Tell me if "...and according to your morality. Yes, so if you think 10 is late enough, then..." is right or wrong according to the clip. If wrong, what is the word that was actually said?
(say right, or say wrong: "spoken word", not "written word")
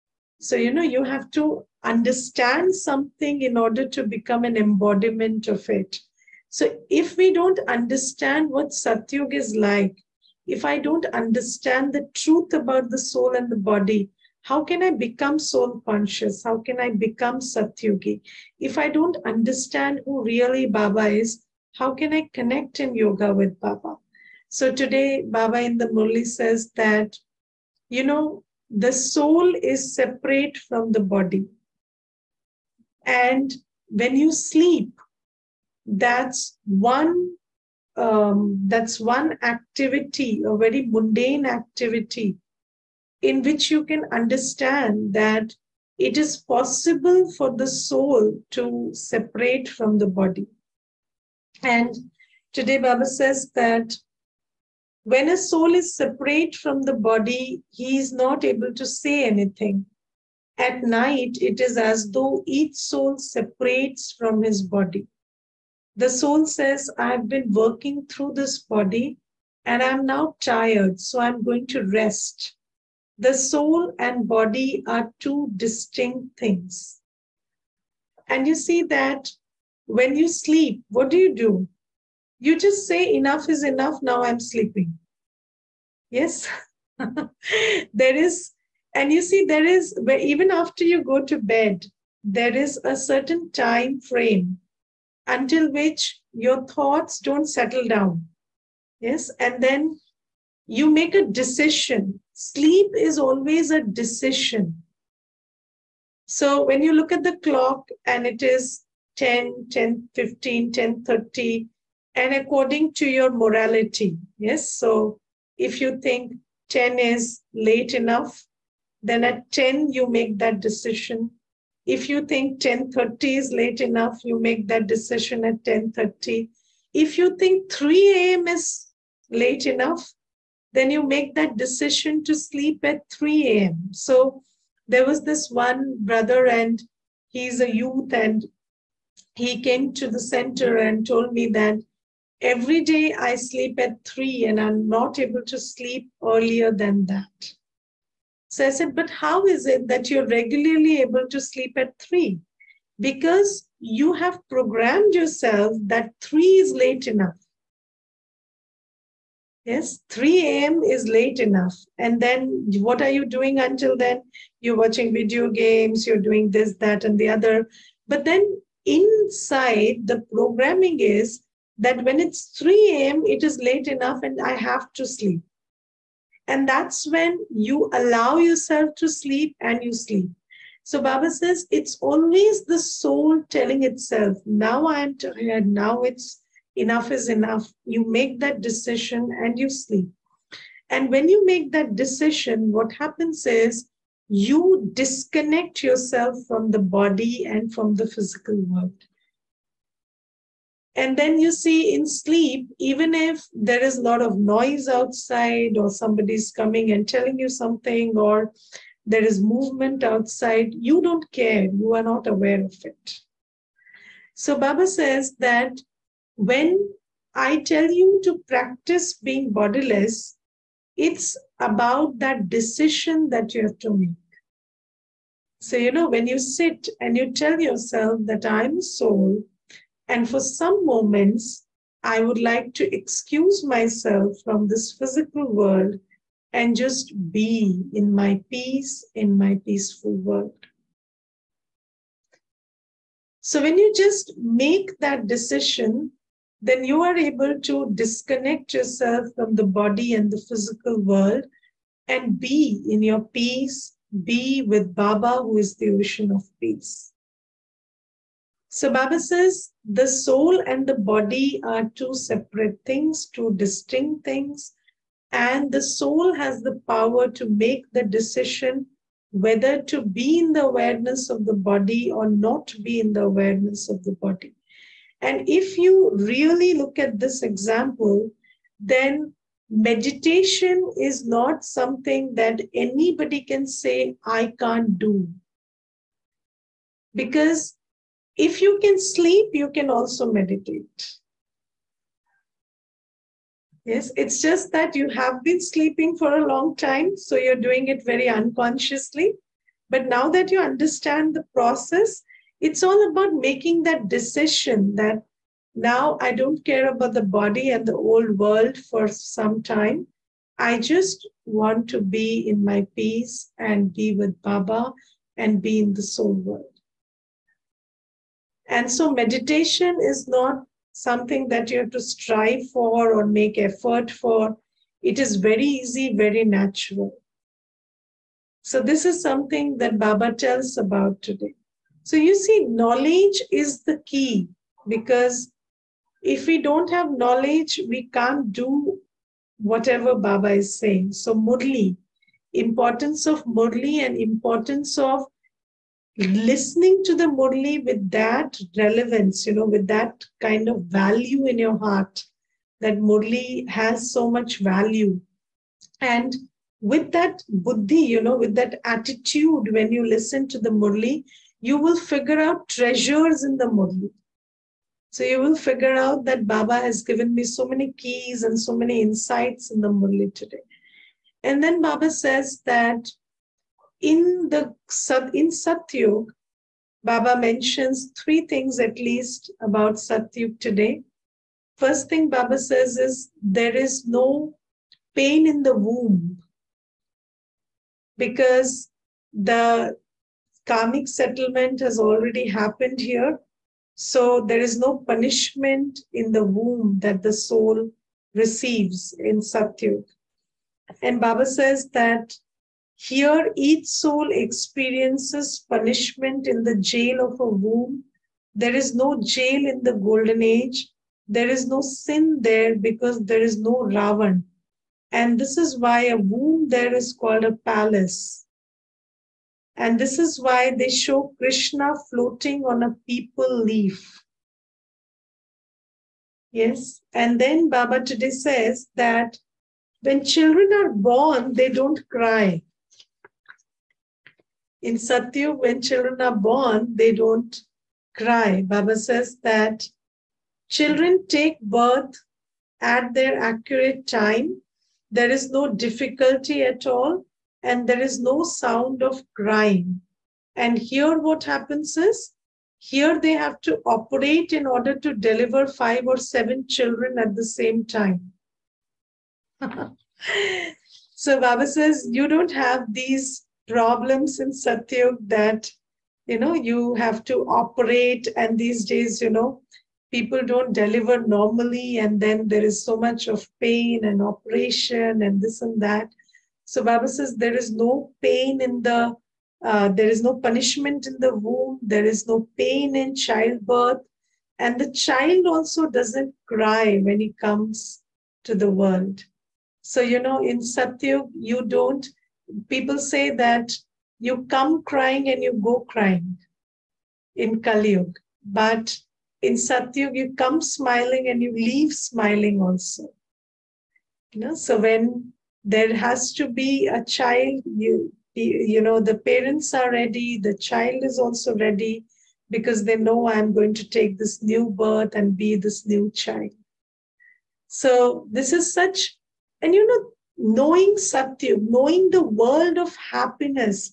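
right.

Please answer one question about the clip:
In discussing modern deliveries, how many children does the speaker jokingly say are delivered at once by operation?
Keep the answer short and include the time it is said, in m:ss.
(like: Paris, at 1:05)
5 or 7, at 7:35.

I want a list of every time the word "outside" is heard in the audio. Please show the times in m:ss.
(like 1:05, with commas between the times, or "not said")
3:24, 3:30.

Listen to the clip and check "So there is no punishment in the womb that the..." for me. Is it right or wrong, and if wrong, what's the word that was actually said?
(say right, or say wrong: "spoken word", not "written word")
right.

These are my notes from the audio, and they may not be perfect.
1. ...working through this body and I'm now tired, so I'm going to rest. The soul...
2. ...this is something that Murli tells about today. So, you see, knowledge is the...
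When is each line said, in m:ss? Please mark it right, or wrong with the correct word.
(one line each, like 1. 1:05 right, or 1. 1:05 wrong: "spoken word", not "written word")
1. 1:07 right
2. 5:28 wrong: "Baba", not "Murli".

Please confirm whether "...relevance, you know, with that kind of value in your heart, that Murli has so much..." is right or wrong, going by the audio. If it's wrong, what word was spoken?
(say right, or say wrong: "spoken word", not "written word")
right.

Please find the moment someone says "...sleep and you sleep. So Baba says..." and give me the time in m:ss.
2:59.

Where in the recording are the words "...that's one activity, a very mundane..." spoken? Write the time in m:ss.
0:38.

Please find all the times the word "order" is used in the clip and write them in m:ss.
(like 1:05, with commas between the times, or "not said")
0:03, 7:34.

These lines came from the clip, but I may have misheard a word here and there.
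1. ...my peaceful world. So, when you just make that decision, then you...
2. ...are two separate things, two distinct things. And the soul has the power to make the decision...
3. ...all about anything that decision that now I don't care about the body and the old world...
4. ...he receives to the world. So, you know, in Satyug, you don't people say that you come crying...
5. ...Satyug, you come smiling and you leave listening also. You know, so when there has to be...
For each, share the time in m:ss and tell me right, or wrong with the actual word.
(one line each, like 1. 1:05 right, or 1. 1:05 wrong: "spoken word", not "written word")
1. 3:59 right
2. 4:21 right
3. 5:02 wrong: "making", not "anything"
4. 8:07 wrong: "comes", not "receives"
5. 8:19 wrong: "smiling", not "listening".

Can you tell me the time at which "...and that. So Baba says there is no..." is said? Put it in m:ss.
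7:55.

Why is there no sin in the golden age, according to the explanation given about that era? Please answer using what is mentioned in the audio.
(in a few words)
There is no Ravan.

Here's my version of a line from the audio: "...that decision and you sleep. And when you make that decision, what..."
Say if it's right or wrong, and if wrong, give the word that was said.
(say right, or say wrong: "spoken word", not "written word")
right.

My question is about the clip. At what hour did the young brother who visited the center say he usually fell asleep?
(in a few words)
3 a.m.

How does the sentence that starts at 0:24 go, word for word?
So today, Baba in the Murli says that, you know, the soul is separate from the body.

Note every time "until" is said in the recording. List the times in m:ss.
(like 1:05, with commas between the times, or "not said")
1:35, 2:43.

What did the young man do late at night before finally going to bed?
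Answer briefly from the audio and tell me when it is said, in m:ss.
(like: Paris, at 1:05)
Video games, at 2:45.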